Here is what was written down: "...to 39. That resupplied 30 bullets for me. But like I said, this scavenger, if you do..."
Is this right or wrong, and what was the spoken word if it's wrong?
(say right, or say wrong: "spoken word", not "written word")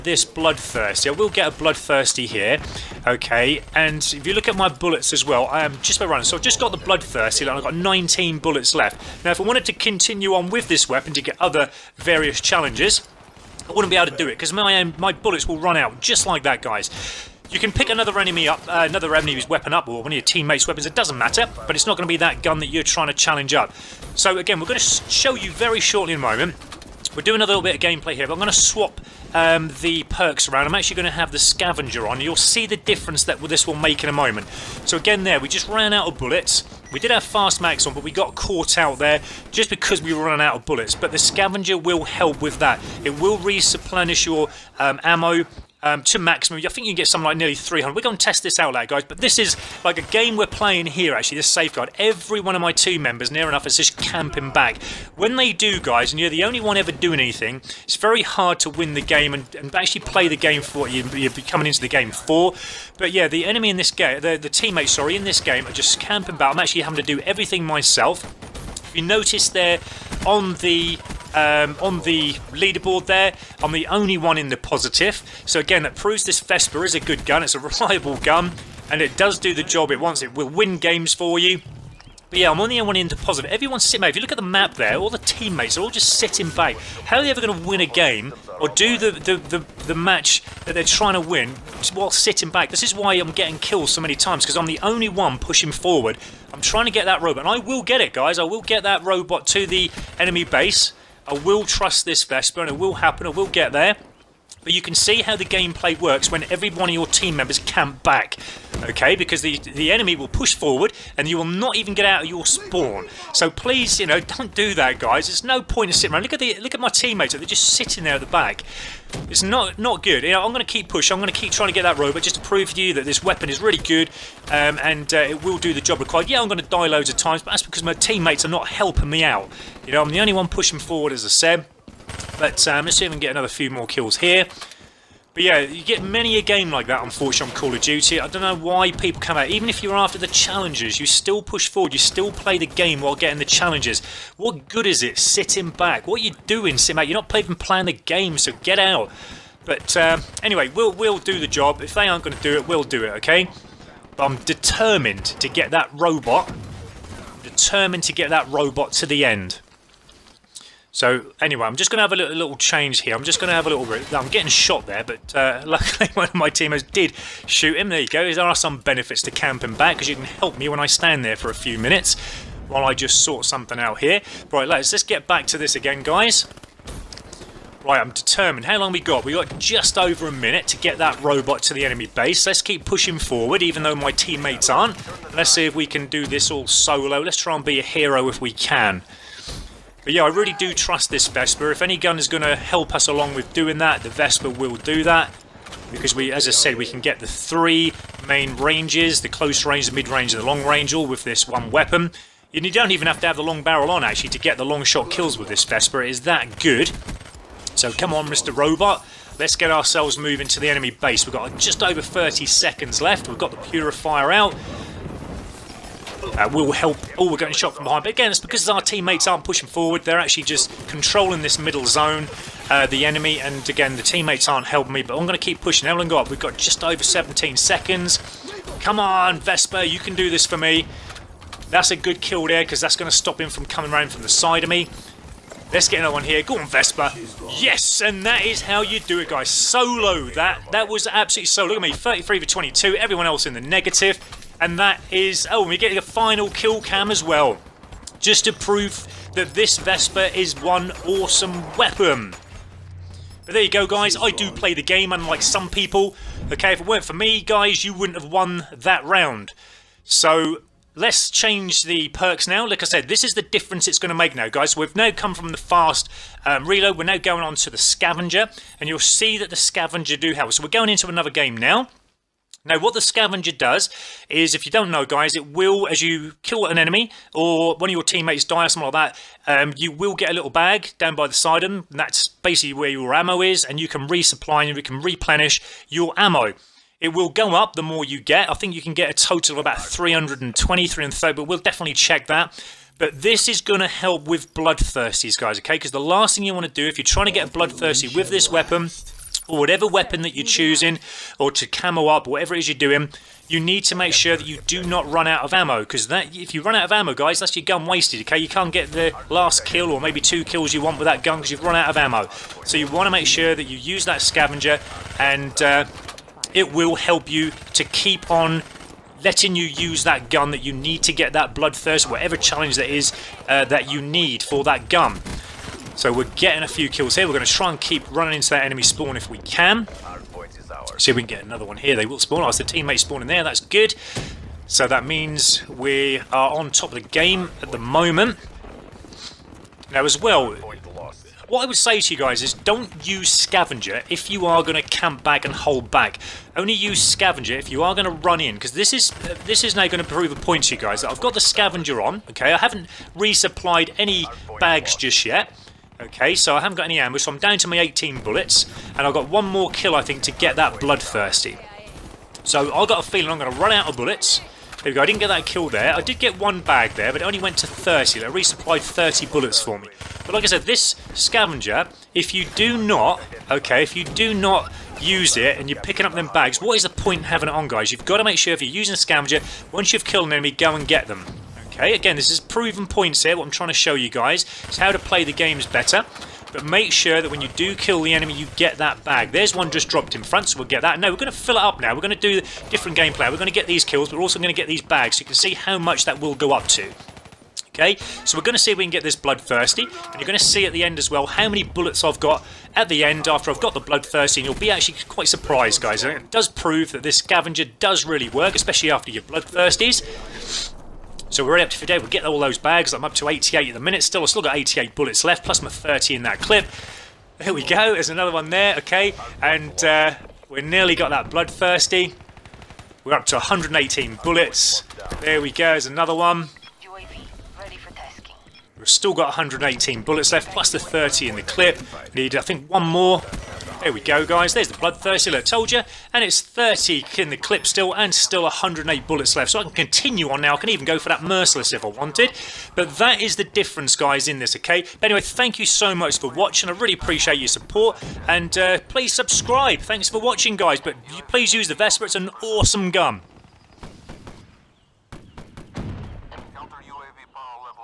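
wrong: "30", not "39".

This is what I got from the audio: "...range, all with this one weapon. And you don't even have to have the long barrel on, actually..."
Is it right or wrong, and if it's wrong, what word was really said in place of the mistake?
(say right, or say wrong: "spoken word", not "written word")
right.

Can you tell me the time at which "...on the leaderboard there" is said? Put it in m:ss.
1:11.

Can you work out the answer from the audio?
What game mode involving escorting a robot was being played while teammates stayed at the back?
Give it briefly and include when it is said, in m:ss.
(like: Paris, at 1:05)
Safeguard, at 0:51.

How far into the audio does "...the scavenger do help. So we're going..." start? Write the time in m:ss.
4:29.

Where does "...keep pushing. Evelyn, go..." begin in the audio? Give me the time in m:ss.
3:45.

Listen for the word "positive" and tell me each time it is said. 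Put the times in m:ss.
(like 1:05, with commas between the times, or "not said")
1:14, 1:23.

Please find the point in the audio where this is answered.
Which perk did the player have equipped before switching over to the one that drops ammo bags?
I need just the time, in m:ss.
0:37.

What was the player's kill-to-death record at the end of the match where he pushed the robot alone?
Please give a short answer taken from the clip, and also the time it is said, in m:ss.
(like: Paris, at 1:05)
33 for 22, at 4:01.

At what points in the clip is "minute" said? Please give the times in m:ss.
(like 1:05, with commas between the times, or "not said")
2:51, 3:00, 6:53.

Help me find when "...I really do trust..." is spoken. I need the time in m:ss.
3:10.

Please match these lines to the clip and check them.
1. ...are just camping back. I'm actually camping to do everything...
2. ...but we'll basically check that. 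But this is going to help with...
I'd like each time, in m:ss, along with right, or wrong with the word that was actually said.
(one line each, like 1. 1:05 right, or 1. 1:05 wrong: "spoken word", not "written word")
1. 1:05 wrong: "having", not "camping"
2. 4:51 wrong: "definitely", not "basically".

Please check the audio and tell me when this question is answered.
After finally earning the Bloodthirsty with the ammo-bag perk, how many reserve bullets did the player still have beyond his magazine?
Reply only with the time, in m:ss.
7:18.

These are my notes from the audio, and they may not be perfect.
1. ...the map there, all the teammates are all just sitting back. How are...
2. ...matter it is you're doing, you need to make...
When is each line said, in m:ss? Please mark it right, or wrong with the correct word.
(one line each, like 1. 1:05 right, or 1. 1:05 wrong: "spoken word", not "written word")
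1. 1:24 right
2. 5:02 wrong: "whatever", not "matter".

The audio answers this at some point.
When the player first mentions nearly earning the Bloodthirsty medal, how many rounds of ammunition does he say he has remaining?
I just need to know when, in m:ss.
0:07.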